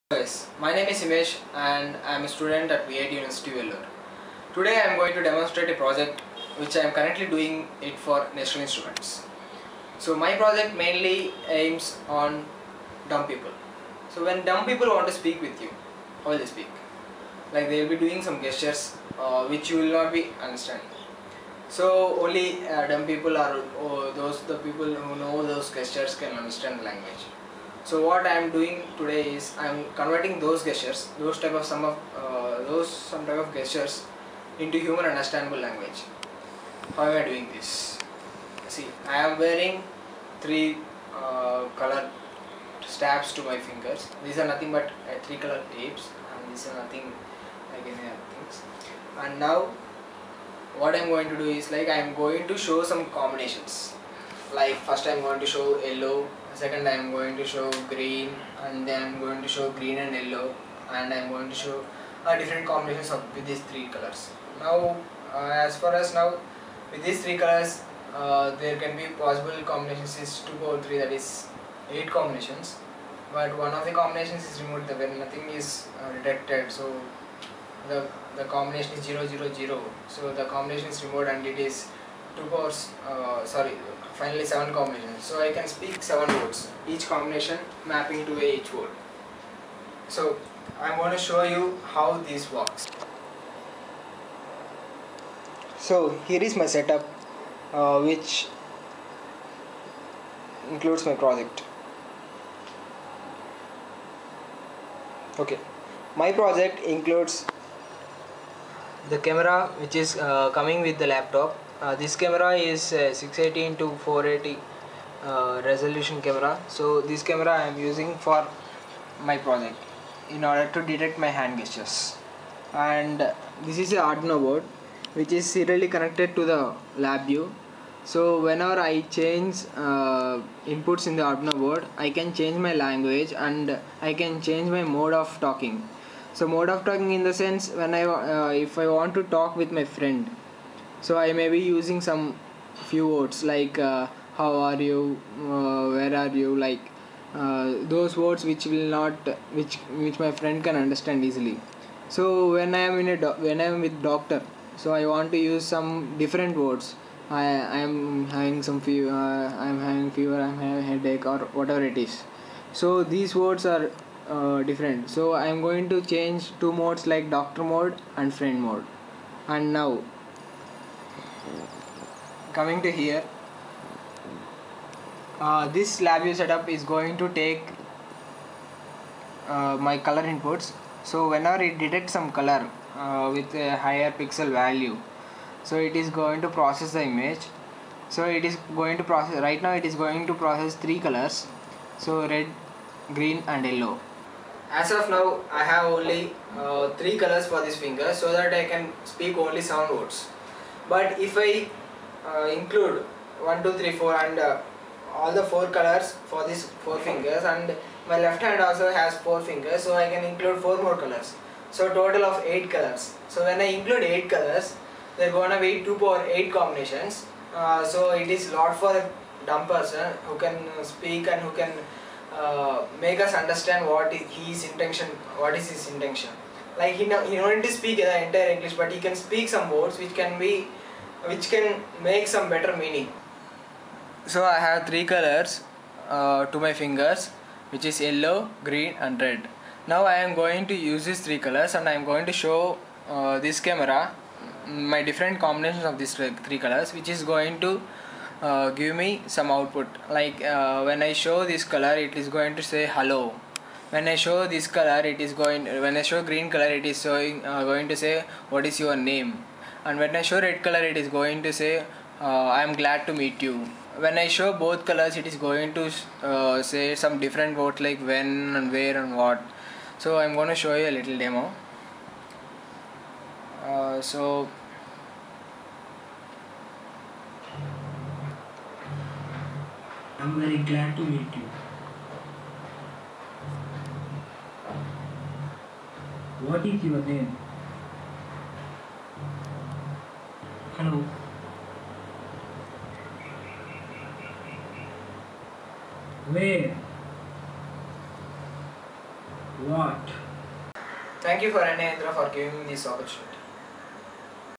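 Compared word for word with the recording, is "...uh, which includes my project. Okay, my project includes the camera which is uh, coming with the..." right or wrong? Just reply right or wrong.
right.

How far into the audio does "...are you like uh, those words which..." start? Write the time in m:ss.
2:26.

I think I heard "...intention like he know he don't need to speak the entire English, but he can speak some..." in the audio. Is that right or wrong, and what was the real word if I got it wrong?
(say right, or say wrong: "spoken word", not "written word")
right.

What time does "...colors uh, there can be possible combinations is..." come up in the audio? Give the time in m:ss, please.
1:07.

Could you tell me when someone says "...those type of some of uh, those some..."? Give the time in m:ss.
0:31.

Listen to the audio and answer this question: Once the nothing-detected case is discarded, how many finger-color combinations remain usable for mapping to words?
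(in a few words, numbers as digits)
7.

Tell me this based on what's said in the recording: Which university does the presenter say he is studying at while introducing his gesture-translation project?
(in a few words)
VIT University Vellore.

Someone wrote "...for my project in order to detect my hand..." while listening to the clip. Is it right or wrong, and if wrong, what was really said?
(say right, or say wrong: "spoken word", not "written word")
right.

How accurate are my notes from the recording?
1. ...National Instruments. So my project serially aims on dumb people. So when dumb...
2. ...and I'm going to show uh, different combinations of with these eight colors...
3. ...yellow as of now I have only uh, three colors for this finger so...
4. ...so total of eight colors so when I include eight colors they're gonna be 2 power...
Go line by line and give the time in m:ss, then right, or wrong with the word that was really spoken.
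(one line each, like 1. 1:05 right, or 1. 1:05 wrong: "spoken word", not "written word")
1. 0:08 wrong: "mainly", not "serially"
2. 1:00 wrong: "three", not "eight"
3. 3:13 right
4. 3:31 right.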